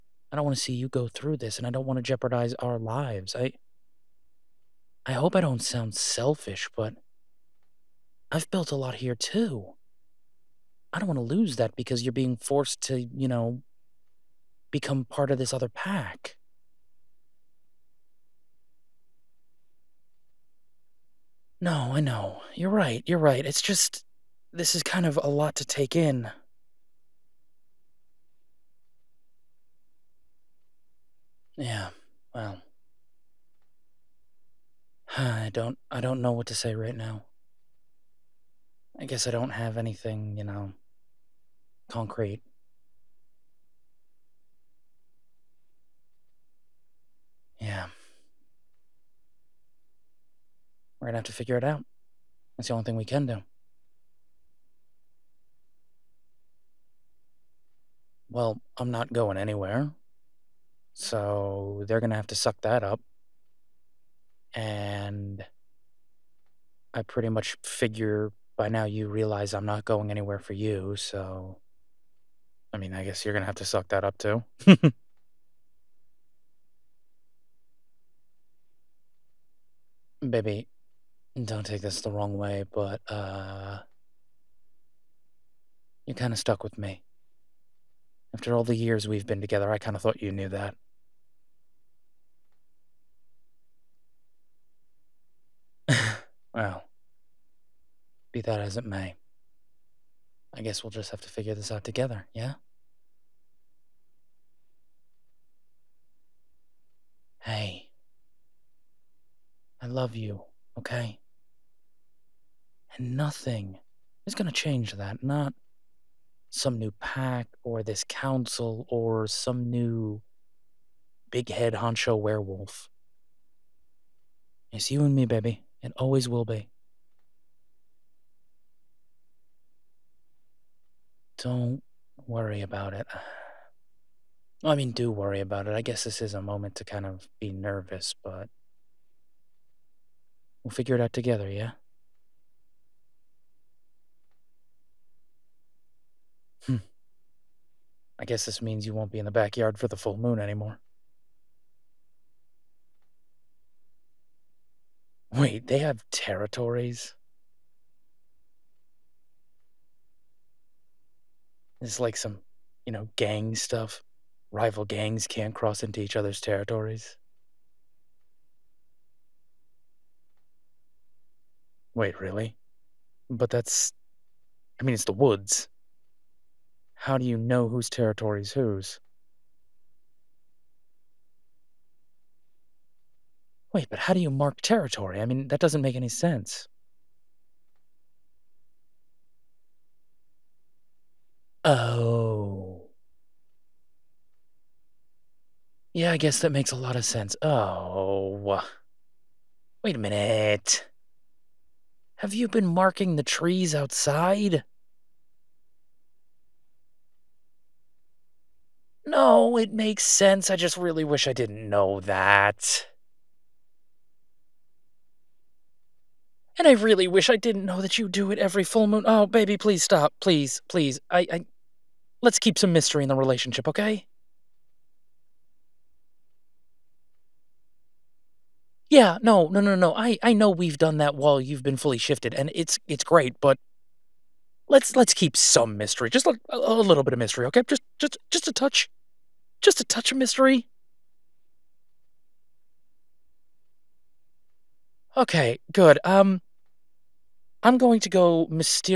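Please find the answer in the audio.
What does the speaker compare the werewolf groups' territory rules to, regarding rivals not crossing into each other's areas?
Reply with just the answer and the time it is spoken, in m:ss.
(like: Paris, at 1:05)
Gang stuff, at 2:43.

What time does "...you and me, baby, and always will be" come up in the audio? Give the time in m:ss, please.
2:04.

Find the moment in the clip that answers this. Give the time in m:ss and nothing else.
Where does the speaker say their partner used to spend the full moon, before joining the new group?
2:29.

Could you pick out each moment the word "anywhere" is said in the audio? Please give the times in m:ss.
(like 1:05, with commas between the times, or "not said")
0:59, 1:10.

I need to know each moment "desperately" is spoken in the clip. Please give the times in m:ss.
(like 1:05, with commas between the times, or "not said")
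not said.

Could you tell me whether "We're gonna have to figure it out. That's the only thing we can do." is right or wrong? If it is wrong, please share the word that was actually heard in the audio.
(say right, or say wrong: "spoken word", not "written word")
right.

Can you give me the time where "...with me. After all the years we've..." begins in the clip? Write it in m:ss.
1:26.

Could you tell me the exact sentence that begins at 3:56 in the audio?
Just a, a little bit of mystery, okay?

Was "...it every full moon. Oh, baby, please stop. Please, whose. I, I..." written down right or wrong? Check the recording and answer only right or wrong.
wrong.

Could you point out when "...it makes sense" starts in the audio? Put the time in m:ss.
3:29.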